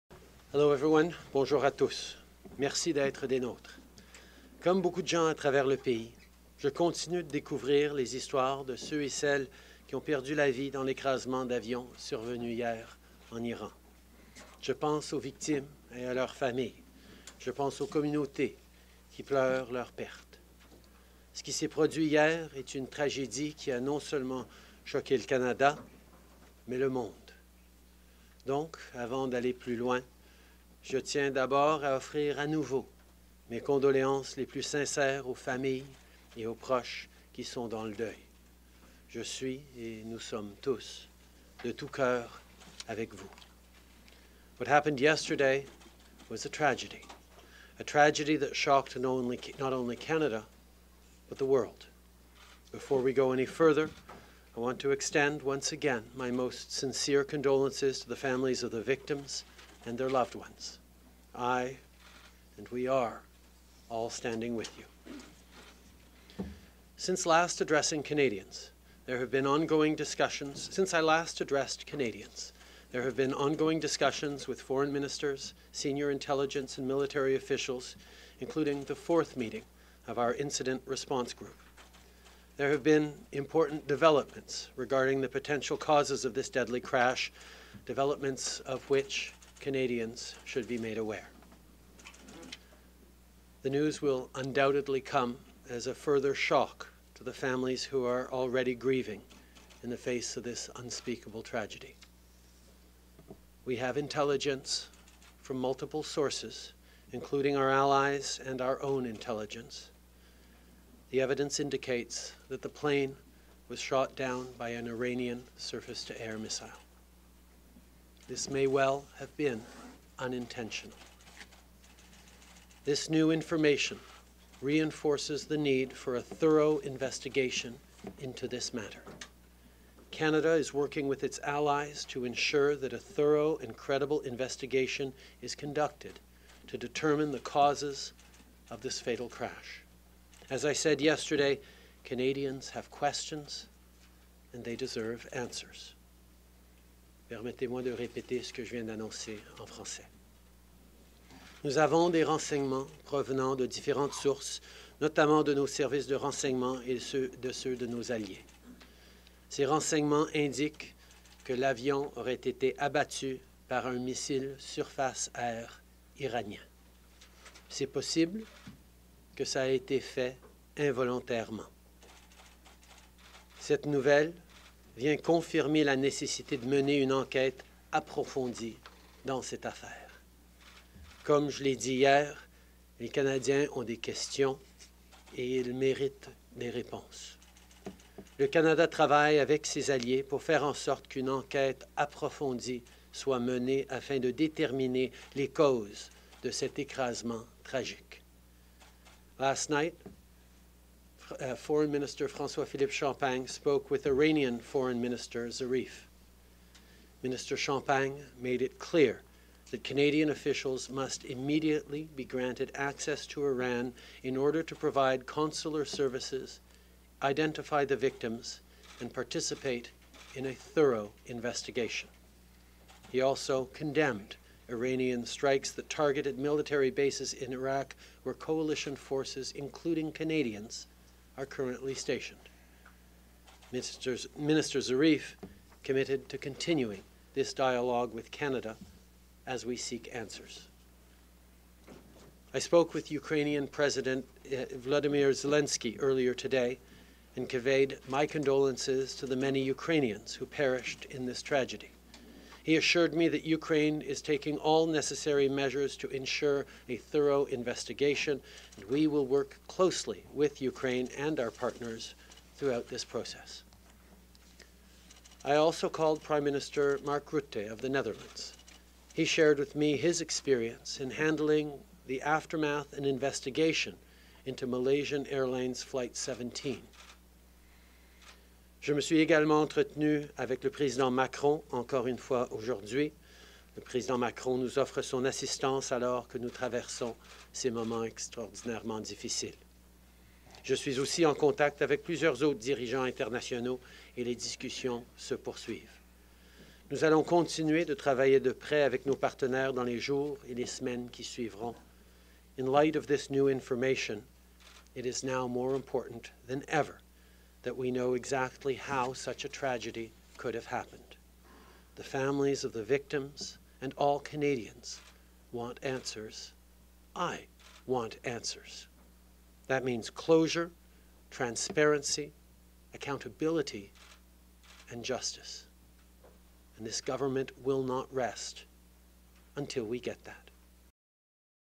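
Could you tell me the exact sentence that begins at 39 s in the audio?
Je suis et nous sommes tous de tout cœur avec vous.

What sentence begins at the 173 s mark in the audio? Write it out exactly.
Cette nouvelle vient confirmer la nécessité de mener une enquête approfondie dans cette affaire.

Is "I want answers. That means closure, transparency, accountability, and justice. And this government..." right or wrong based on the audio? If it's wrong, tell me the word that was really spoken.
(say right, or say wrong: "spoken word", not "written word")
right.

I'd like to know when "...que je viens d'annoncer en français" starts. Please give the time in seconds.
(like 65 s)
148 s.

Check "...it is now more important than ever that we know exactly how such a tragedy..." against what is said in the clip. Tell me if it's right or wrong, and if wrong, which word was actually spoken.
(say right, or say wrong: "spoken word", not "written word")
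right.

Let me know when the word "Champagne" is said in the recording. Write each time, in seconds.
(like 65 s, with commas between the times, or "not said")
202 s, 207 s.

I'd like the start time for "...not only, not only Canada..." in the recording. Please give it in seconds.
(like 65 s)
48 s.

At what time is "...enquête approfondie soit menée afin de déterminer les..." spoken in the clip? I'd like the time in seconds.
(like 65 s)
191 s.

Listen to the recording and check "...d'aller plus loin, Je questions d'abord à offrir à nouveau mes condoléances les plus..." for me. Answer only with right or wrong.
wrong.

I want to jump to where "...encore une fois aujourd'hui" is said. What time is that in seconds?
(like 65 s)
281 s.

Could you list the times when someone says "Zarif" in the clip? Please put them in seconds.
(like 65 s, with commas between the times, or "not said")
205 s, 234 s.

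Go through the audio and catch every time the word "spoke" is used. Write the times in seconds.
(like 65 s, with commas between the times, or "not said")
203 s, 242 s.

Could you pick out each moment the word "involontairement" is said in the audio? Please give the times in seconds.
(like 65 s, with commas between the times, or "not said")
170 s.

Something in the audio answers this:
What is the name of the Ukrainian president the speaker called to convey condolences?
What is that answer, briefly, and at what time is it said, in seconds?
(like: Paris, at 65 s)
Vladimir Zelensky, at 244 s.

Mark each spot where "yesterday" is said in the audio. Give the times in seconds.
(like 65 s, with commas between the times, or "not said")
44 s, 141 s.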